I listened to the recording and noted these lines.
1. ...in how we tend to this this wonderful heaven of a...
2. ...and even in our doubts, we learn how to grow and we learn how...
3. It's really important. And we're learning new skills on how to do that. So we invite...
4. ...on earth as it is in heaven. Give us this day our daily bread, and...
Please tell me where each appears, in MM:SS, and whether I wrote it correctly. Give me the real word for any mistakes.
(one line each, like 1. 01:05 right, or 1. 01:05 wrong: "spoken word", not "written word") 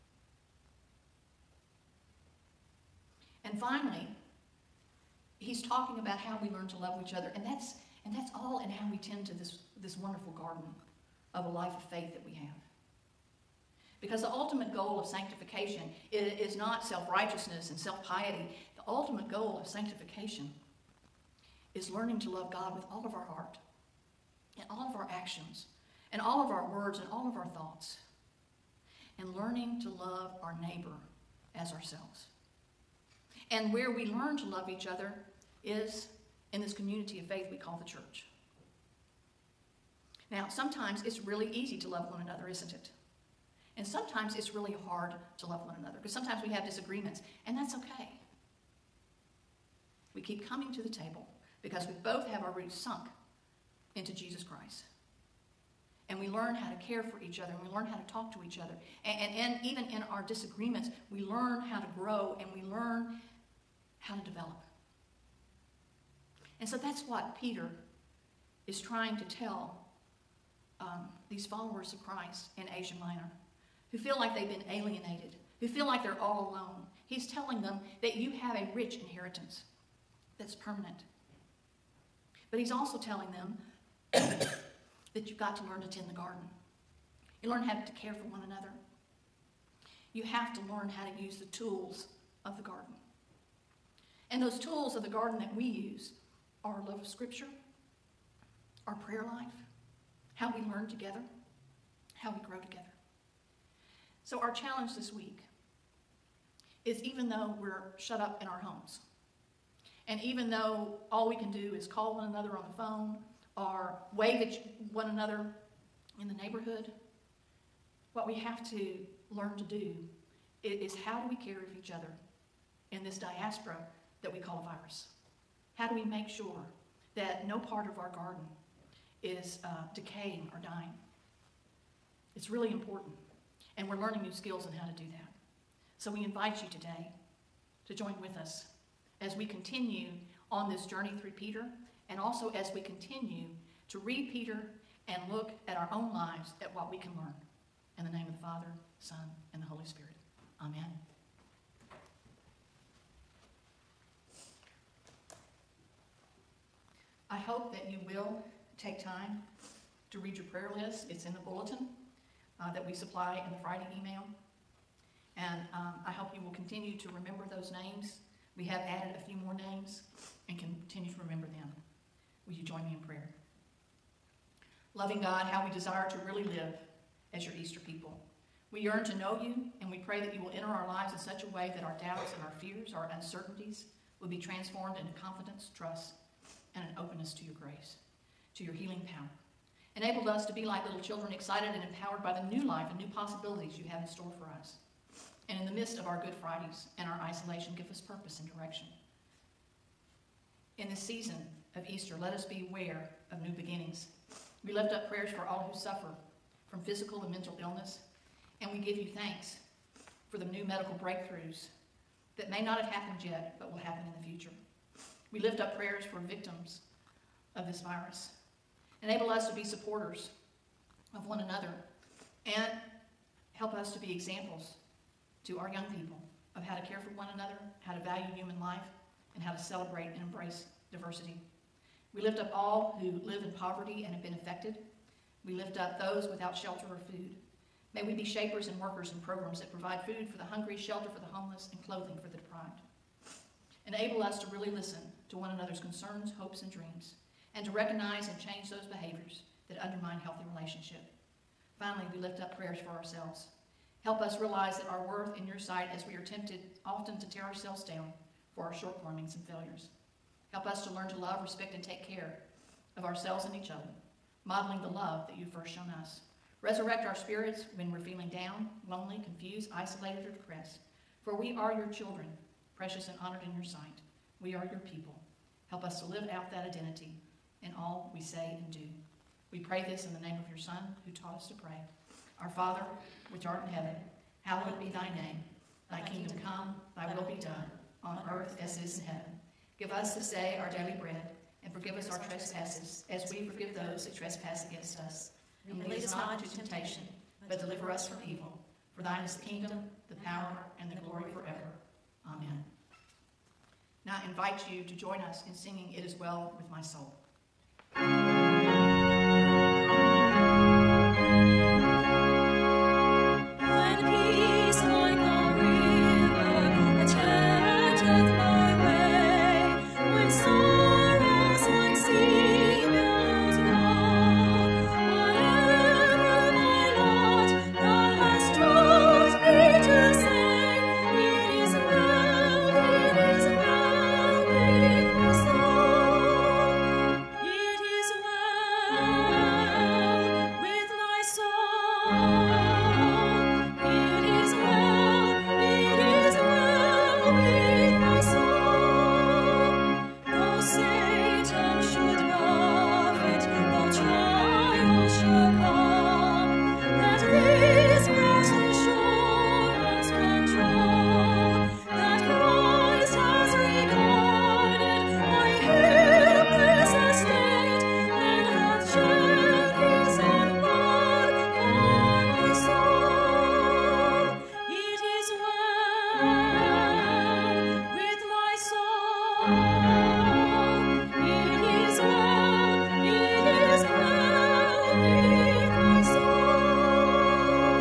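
1. 00:08 wrong: "garden", not "heaven"
2. 00:59 wrong: "disagreements", not "doubts"
3. 02:12 right
4. 04:48 right.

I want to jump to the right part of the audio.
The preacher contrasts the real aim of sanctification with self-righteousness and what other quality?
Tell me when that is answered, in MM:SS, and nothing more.
00:17.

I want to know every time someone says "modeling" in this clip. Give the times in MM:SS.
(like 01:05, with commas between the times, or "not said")
04:24.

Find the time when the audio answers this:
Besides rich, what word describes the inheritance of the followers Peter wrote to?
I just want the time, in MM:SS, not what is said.
01:20.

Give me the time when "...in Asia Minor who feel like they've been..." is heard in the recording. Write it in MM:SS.
01:12.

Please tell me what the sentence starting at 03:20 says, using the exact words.
In this season of Easter, let us beware of new beginnings.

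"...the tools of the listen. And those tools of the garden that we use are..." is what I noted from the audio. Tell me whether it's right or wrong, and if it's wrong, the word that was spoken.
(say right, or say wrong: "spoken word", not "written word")
wrong: "garden", not "listen".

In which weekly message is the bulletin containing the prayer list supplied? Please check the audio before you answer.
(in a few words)
the Friday email.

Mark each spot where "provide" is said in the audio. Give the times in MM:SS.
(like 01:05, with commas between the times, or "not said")
03:59.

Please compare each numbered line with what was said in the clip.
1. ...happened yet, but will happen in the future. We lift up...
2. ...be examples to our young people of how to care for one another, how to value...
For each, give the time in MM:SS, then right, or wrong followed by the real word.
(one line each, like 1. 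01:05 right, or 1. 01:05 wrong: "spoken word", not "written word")
1. 03:32 right
2. 03:43 right.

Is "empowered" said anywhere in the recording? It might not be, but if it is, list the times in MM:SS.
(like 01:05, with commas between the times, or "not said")
03:11.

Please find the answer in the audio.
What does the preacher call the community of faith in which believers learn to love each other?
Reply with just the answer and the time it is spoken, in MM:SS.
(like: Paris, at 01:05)
the church, at 00:37.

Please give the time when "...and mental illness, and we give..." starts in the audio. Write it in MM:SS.
03:27.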